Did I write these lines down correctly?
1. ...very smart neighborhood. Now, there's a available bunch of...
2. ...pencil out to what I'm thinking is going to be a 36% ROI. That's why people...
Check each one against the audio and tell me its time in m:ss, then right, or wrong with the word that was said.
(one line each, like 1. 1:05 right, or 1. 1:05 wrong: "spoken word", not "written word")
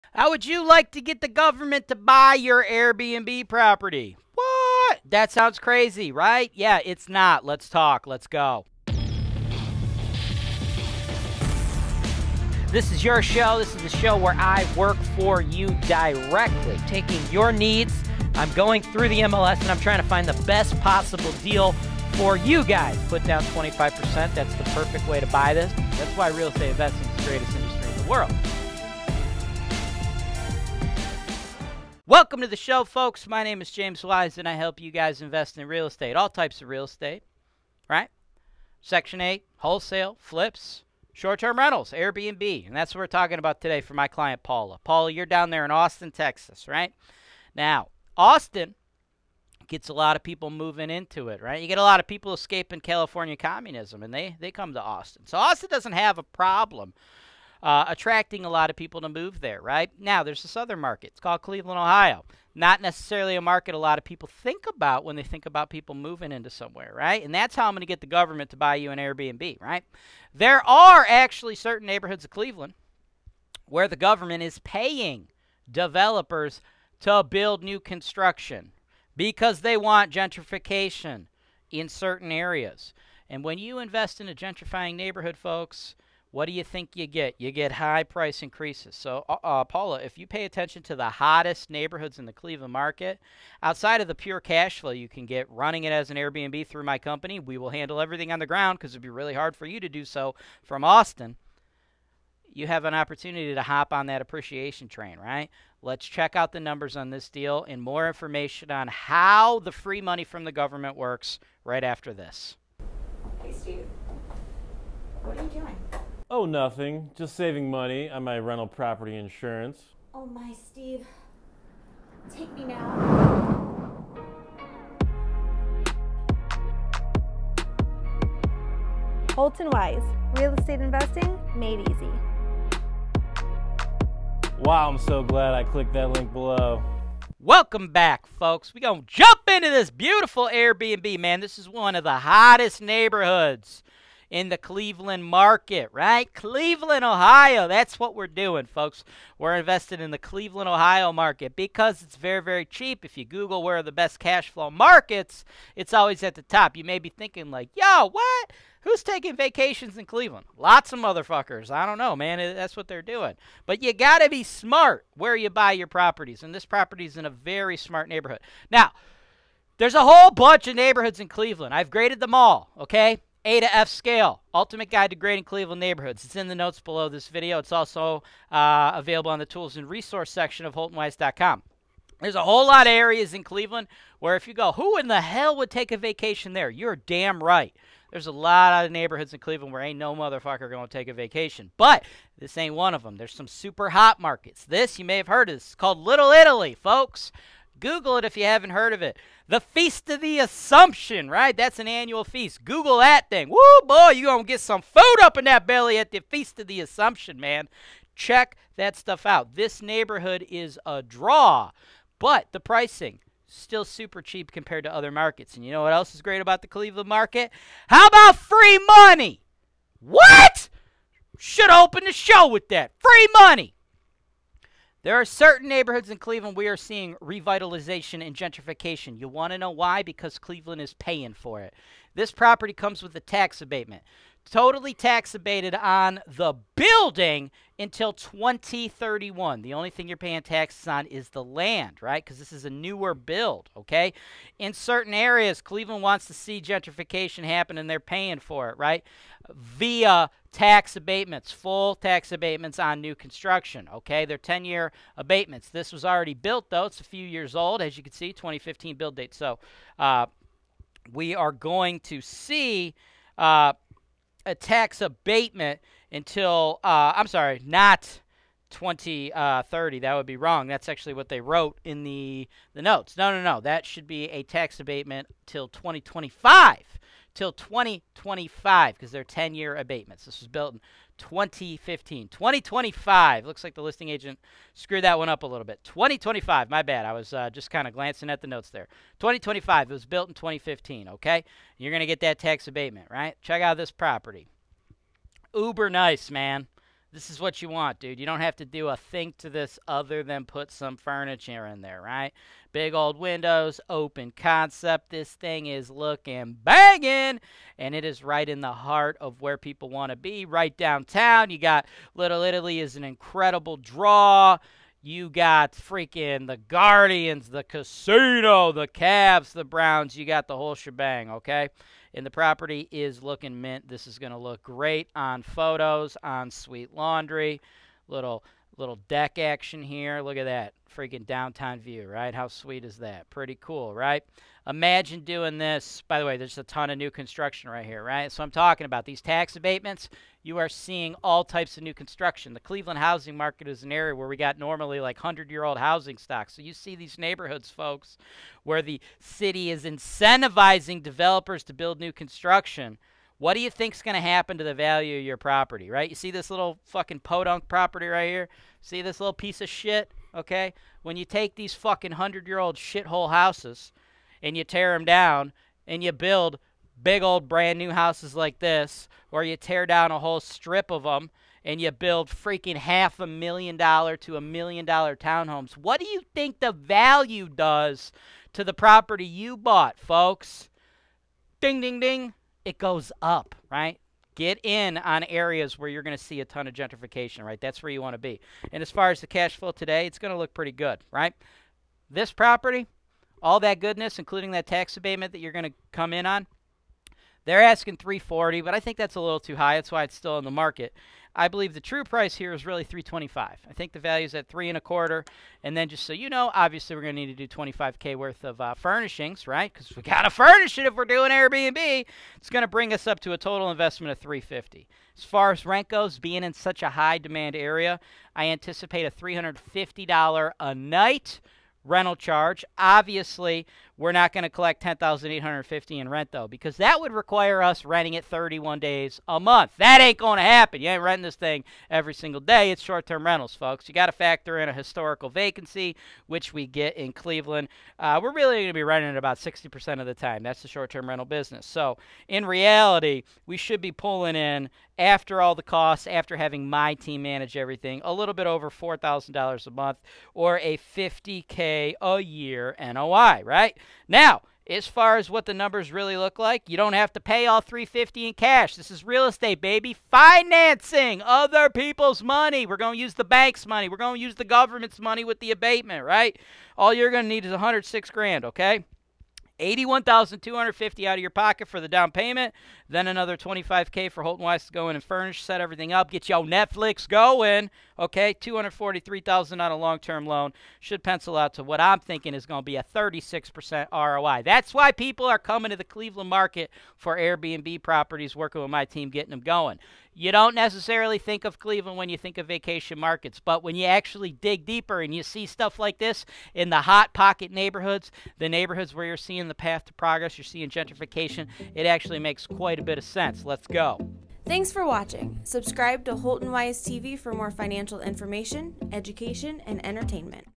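1. 2:47 wrong: "whole", not "available"
2. 8:01 right.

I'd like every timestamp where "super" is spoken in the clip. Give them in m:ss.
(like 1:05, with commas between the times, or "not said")
3:13, 3:33.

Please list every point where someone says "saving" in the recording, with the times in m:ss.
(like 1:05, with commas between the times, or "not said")
1:57.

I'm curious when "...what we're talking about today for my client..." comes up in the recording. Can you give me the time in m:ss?
0:42.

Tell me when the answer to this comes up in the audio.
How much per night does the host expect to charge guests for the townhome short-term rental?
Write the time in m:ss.
6:59.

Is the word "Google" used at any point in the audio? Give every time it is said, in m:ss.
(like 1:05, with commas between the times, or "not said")
2:33, 3:17, 3:22.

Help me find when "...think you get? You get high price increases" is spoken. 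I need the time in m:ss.
1:26.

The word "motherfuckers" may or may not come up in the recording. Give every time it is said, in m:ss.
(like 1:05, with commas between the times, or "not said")
2:40, 3:10.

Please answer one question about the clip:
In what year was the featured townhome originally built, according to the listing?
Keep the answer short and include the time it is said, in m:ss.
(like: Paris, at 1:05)
2015, at 4:18.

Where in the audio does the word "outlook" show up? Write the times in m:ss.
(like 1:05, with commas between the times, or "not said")
not said.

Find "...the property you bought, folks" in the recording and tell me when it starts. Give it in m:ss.
6:18.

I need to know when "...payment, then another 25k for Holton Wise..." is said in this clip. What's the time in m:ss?
7:52.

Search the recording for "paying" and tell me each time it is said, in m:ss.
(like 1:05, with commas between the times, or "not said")
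1:14, 3:50, 4:00, 4:07.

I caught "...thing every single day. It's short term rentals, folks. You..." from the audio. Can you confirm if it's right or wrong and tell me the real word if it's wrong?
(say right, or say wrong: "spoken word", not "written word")
right.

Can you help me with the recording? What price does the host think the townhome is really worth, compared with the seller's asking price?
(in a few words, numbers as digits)
325,000.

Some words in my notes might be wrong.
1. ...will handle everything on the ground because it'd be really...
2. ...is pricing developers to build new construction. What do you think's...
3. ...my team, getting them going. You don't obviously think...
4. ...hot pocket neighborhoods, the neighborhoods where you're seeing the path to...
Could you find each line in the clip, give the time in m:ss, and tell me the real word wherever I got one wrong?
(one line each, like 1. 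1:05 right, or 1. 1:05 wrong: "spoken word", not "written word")
1. 1:37 right
2. 5:49 wrong: "incentivizing", not "pricing"
3. 8:08 wrong: "necessarily", not "obviously"
4. 8:16 right.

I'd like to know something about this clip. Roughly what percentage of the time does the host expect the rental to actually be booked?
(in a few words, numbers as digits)
60%.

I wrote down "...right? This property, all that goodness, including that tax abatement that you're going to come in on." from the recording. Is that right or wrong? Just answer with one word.
right.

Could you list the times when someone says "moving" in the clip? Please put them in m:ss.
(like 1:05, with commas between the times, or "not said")
0:50, 1:05.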